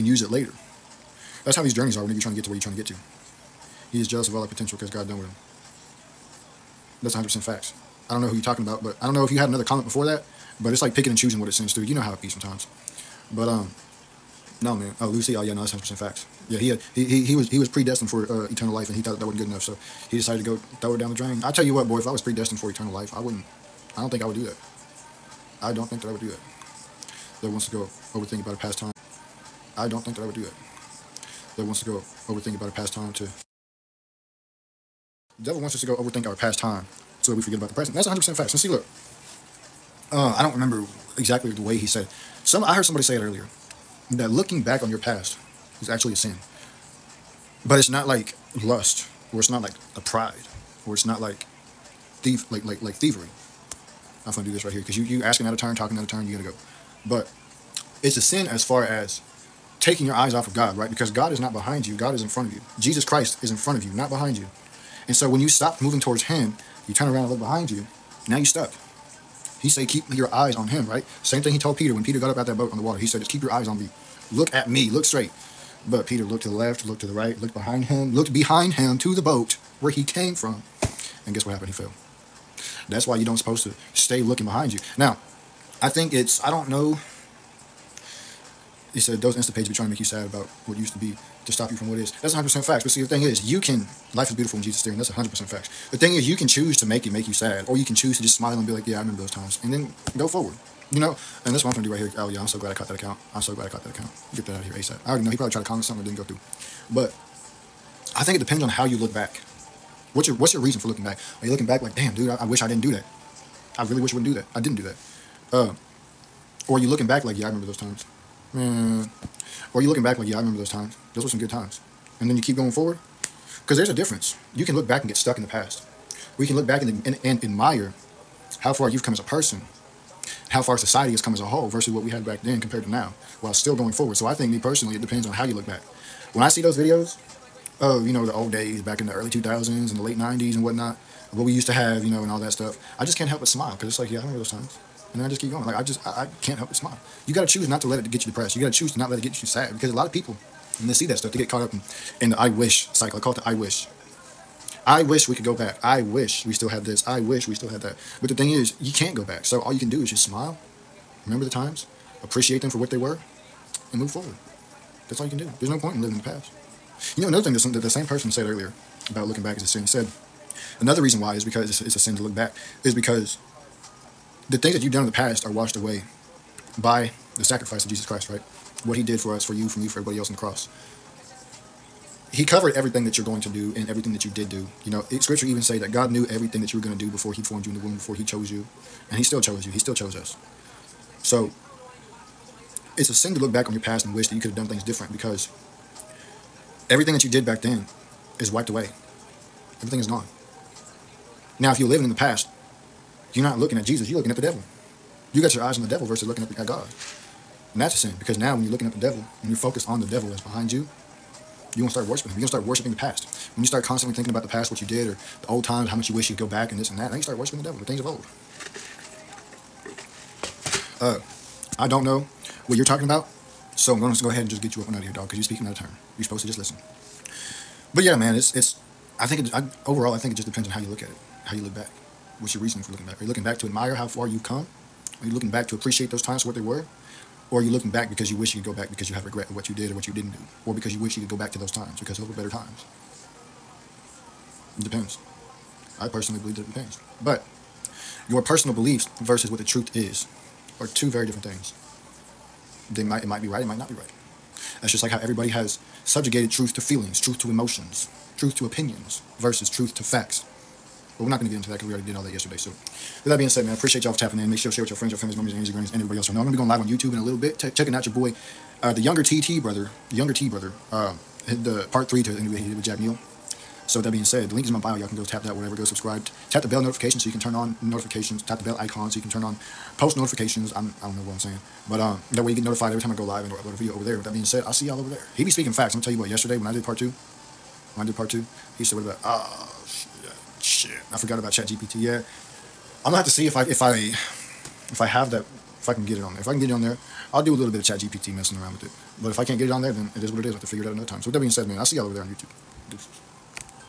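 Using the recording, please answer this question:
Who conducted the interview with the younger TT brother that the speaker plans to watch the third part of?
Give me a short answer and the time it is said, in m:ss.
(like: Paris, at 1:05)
Jack Neel, at 4:32.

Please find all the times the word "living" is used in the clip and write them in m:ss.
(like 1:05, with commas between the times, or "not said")
2:46, 3:21.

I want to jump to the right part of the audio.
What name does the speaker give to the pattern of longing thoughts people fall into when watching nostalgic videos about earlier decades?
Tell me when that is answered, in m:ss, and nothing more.
2:32.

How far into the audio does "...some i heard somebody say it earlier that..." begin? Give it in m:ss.
0:42.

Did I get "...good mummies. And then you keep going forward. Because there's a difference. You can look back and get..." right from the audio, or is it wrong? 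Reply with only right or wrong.
wrong.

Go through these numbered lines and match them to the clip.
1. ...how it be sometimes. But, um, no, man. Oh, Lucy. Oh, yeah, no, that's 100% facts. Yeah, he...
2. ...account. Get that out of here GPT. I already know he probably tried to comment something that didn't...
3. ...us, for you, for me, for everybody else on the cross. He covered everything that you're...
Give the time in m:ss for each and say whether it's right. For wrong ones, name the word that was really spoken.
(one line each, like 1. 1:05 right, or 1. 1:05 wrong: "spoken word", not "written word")
1. 0:12 right
2. 1:43 wrong: "ASAP", not "GPT"
3. 2:59 right.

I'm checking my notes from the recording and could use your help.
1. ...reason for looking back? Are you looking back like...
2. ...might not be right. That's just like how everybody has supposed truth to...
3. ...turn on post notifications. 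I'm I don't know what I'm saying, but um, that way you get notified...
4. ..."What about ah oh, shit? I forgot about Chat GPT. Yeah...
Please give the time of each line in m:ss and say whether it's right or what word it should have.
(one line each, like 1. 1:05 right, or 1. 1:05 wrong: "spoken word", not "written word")
1. 1:50 right
2. 4:13 wrong: "subjugated", not "supposed"
3. 4:39 right
4. 4:48 right.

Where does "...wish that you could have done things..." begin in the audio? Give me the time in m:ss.
3:14.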